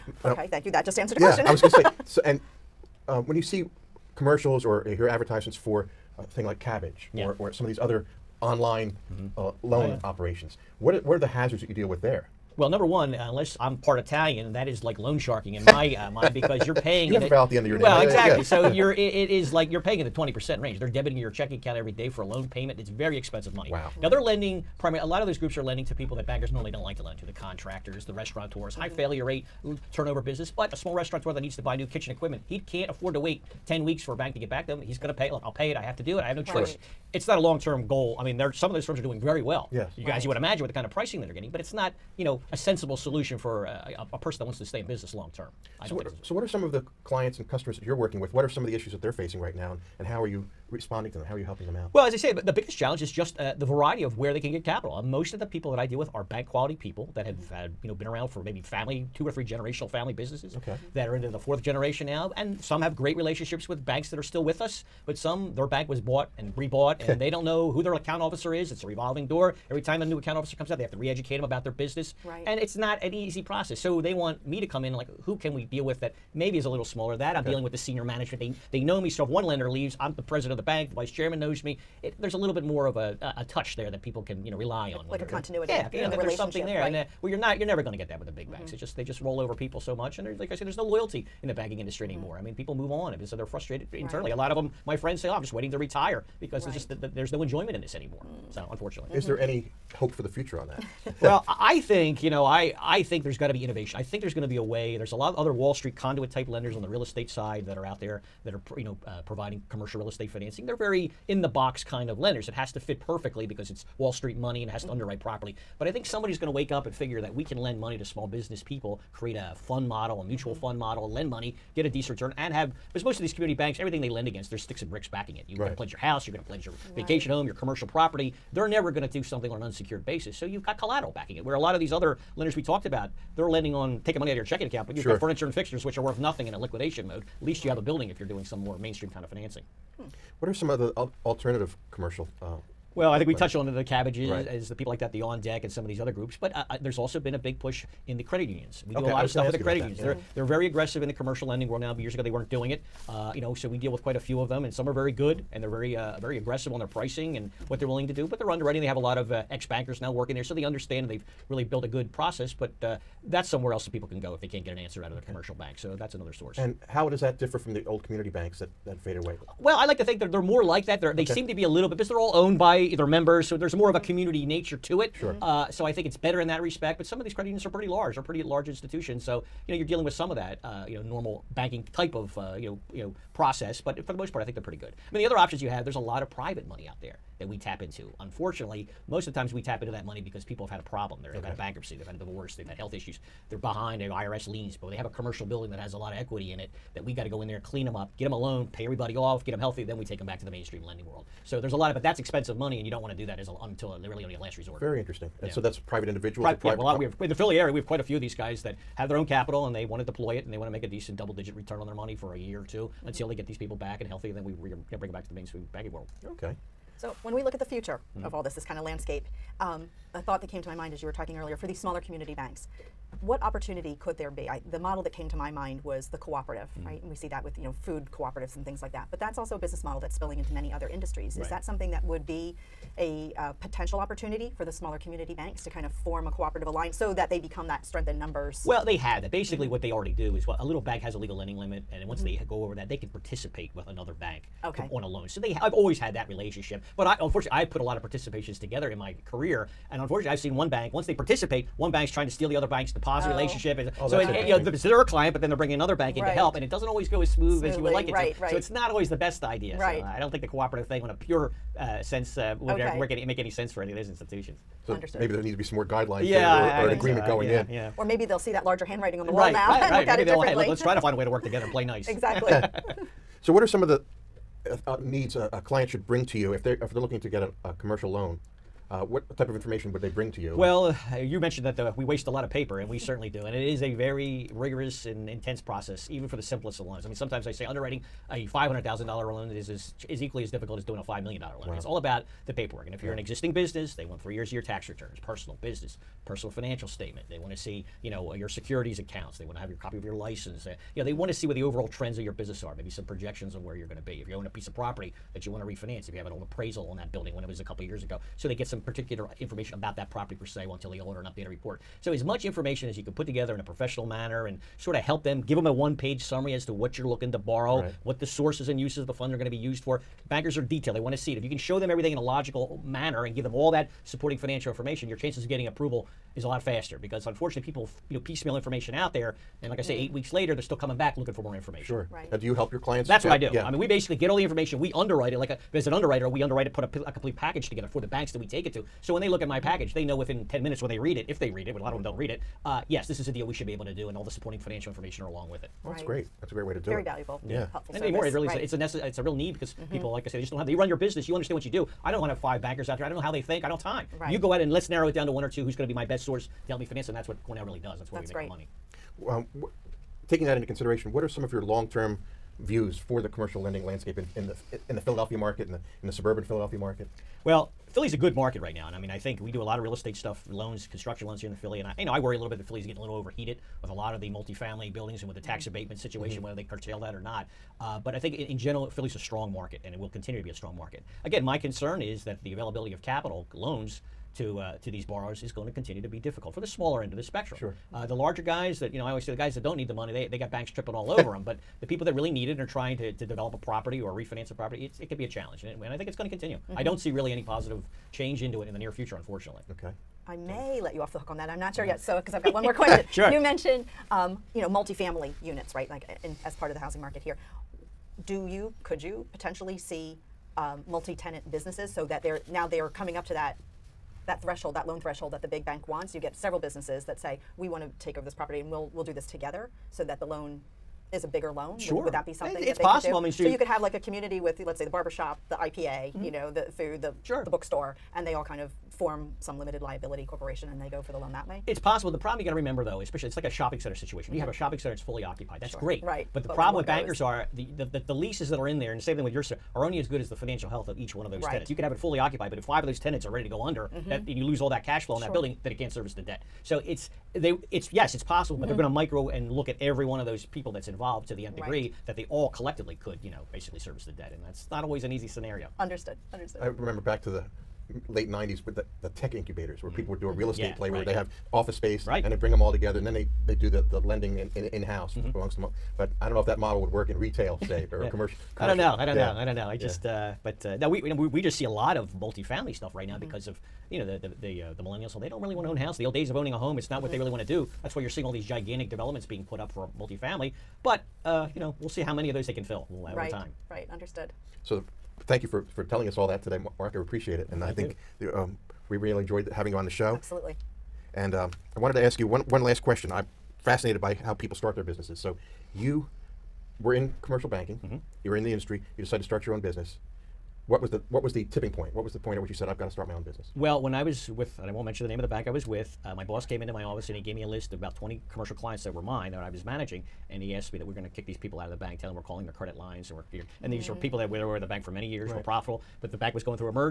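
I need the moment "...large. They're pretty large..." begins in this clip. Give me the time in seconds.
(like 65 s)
177 s.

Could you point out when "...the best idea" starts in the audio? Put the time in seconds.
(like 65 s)
259 s.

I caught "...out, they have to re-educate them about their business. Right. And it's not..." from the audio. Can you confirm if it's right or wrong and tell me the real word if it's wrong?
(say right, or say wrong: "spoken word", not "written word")
right.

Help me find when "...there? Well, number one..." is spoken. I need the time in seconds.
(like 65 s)
12 s.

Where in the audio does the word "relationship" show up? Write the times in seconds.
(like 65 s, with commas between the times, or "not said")
63 s, 246 s, 253 s.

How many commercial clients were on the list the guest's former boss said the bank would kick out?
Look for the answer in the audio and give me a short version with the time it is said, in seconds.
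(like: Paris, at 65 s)
about 20, at 507 s.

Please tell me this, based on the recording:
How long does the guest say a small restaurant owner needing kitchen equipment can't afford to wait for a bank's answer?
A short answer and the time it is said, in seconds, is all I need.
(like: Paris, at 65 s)
10 weeks, at 33 s.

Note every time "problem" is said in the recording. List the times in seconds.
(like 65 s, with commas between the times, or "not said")
190 s, 432 s, 436 s.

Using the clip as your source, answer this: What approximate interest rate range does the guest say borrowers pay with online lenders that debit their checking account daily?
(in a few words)
20 percent range.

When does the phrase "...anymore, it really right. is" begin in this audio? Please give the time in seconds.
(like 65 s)
348 s.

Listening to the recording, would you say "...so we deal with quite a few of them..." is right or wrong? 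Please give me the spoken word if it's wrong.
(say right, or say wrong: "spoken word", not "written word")
right.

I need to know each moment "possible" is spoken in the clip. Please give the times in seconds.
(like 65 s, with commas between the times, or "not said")
422 s, 431 s, 448 s.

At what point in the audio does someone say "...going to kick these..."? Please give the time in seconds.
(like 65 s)
510 s.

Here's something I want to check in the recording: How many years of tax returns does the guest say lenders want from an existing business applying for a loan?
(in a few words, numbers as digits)
3.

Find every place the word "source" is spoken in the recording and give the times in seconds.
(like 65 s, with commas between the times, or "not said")
166 s, 318 s, 356 s.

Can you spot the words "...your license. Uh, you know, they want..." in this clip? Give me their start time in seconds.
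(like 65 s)
300 s.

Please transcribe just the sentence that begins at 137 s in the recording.
At least you have a building if you're doing some more mainstream kind of financing.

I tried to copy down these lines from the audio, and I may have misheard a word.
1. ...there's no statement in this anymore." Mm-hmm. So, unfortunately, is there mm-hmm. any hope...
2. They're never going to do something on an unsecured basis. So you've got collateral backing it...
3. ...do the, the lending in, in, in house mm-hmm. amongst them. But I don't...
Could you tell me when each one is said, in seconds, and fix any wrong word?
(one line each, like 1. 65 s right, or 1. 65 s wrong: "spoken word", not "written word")
1. 97 s wrong: "enjoyment", not "statement"
2. 128 s right
3. 463 s right.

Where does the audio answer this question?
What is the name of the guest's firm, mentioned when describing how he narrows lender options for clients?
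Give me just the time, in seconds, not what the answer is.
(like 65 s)
357 s.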